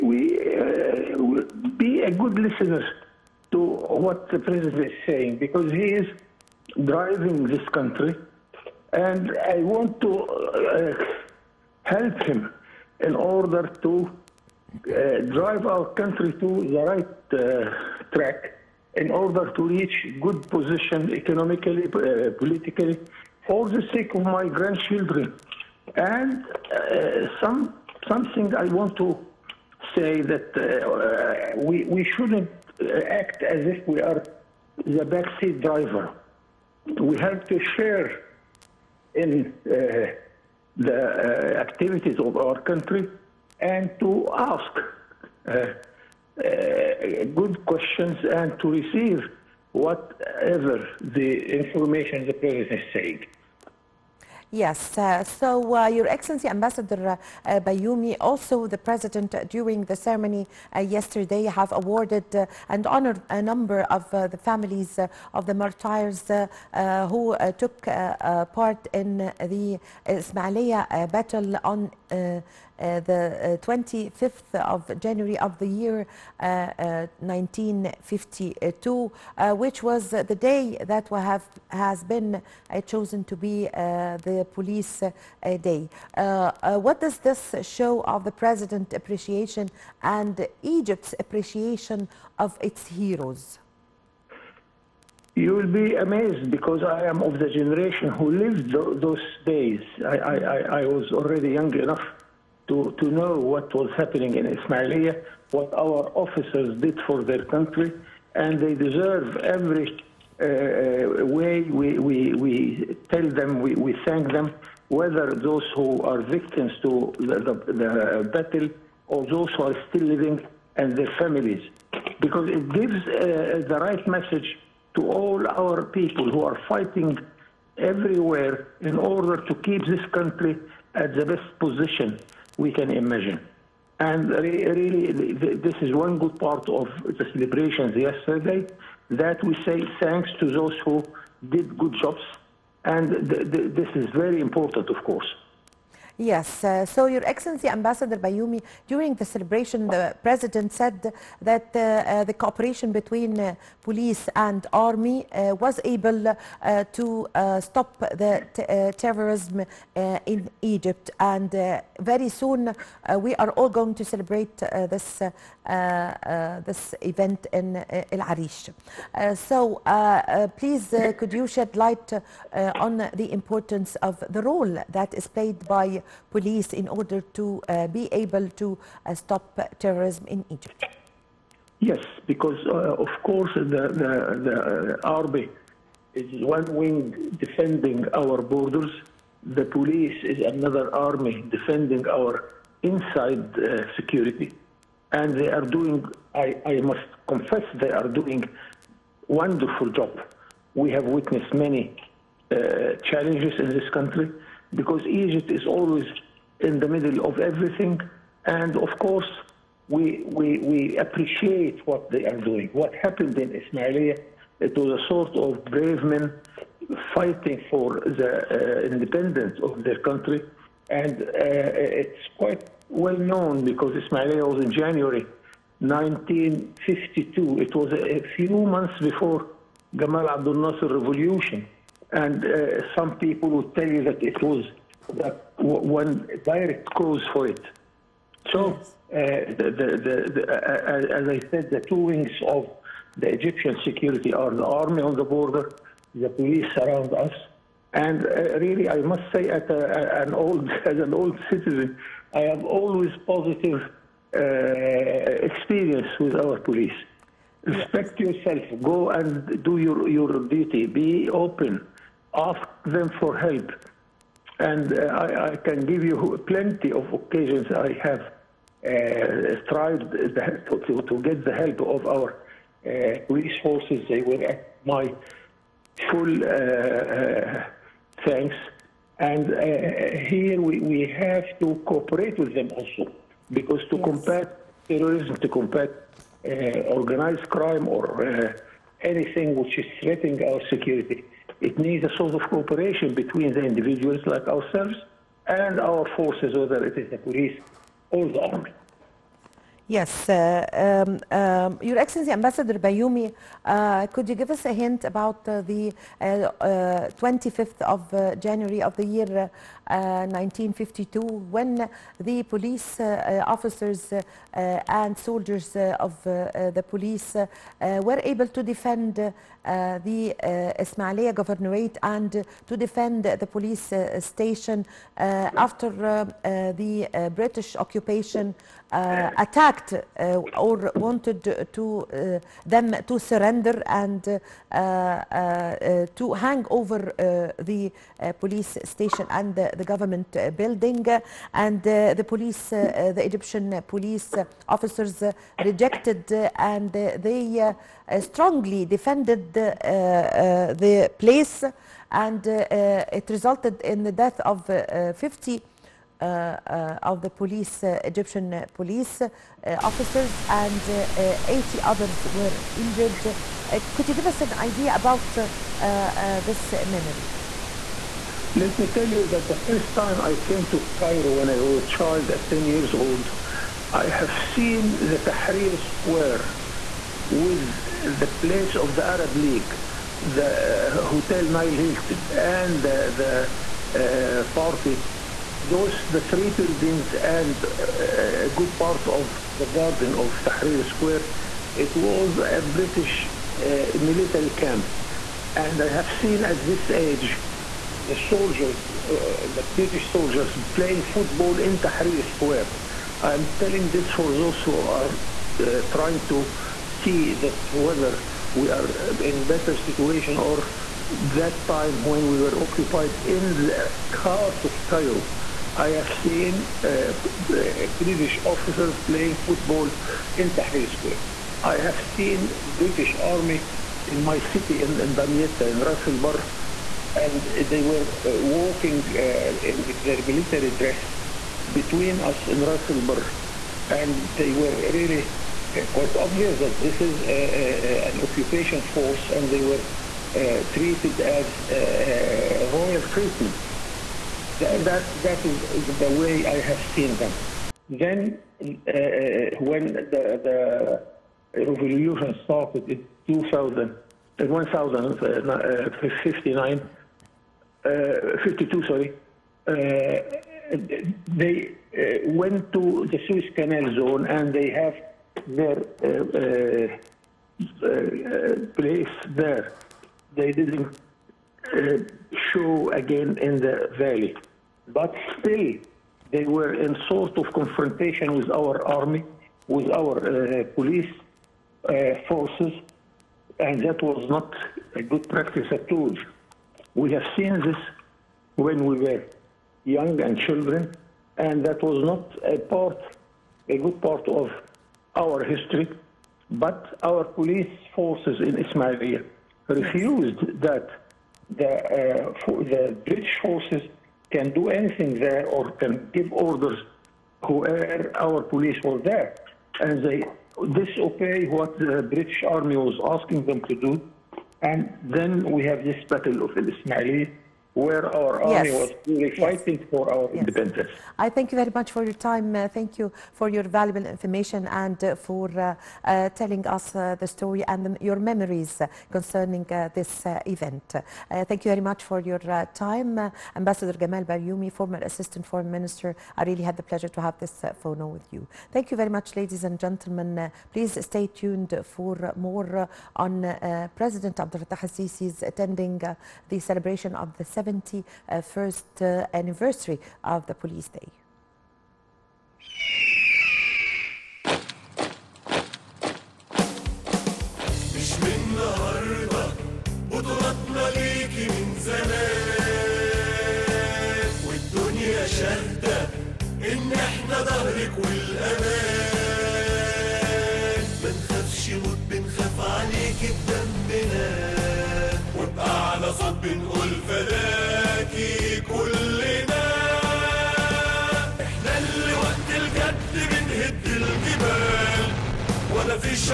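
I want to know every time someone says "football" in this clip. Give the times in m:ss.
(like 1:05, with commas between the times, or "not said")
6:41, 6:59.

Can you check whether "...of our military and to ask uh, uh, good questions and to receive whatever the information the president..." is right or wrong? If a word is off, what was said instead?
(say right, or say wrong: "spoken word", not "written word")
wrong: "country", not "military".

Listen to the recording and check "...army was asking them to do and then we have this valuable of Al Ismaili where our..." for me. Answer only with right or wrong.
wrong.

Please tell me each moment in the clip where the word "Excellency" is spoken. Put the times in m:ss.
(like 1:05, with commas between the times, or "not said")
0:56, 2:27, 5:01.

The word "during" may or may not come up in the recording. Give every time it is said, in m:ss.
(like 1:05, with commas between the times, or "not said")
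0:59, 2:28.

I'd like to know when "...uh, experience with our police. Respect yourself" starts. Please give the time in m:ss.
4:14.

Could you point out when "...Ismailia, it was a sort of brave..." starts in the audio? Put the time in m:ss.
3:33.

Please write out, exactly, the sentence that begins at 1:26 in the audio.
what does this show of the President's appreciation and Egypt's appreciation of its heroes?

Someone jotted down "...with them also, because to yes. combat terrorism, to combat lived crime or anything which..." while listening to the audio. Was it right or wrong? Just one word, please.
wrong.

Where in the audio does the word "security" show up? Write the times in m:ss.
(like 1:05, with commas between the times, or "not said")
3:13, 4:03, 4:50.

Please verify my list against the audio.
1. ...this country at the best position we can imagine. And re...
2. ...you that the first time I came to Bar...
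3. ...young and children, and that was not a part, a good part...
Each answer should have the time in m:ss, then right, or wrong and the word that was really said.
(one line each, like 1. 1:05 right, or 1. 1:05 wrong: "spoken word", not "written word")
1. 2:09 right
2. 6:09 wrong: "Cairo", not "Bar"
3. 8:09 right.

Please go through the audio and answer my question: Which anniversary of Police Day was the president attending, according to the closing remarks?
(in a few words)
71st.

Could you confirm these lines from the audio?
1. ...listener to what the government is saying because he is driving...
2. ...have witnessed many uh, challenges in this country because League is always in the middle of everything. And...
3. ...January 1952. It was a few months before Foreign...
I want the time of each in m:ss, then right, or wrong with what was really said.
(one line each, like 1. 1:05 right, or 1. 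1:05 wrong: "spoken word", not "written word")
1. 0:02 wrong: "president", not "government"
2. 3:20 wrong: "Egypt", not "League"
3. 3:44 wrong: "Gamal", not "Foreign".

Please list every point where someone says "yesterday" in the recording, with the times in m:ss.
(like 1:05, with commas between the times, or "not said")
1:00, 2:18.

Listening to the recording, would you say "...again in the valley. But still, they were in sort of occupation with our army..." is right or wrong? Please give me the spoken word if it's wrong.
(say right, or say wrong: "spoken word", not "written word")
wrong: "confrontation", not "occupation".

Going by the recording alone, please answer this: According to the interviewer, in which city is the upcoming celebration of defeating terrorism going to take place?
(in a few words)
El Arish.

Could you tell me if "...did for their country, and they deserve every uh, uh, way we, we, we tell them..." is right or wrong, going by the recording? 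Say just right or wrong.
right.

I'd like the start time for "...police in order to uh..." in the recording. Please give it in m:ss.
2:56.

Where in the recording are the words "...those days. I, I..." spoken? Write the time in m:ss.
1:39.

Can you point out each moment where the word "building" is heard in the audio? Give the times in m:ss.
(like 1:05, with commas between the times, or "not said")
5:40, 6:26.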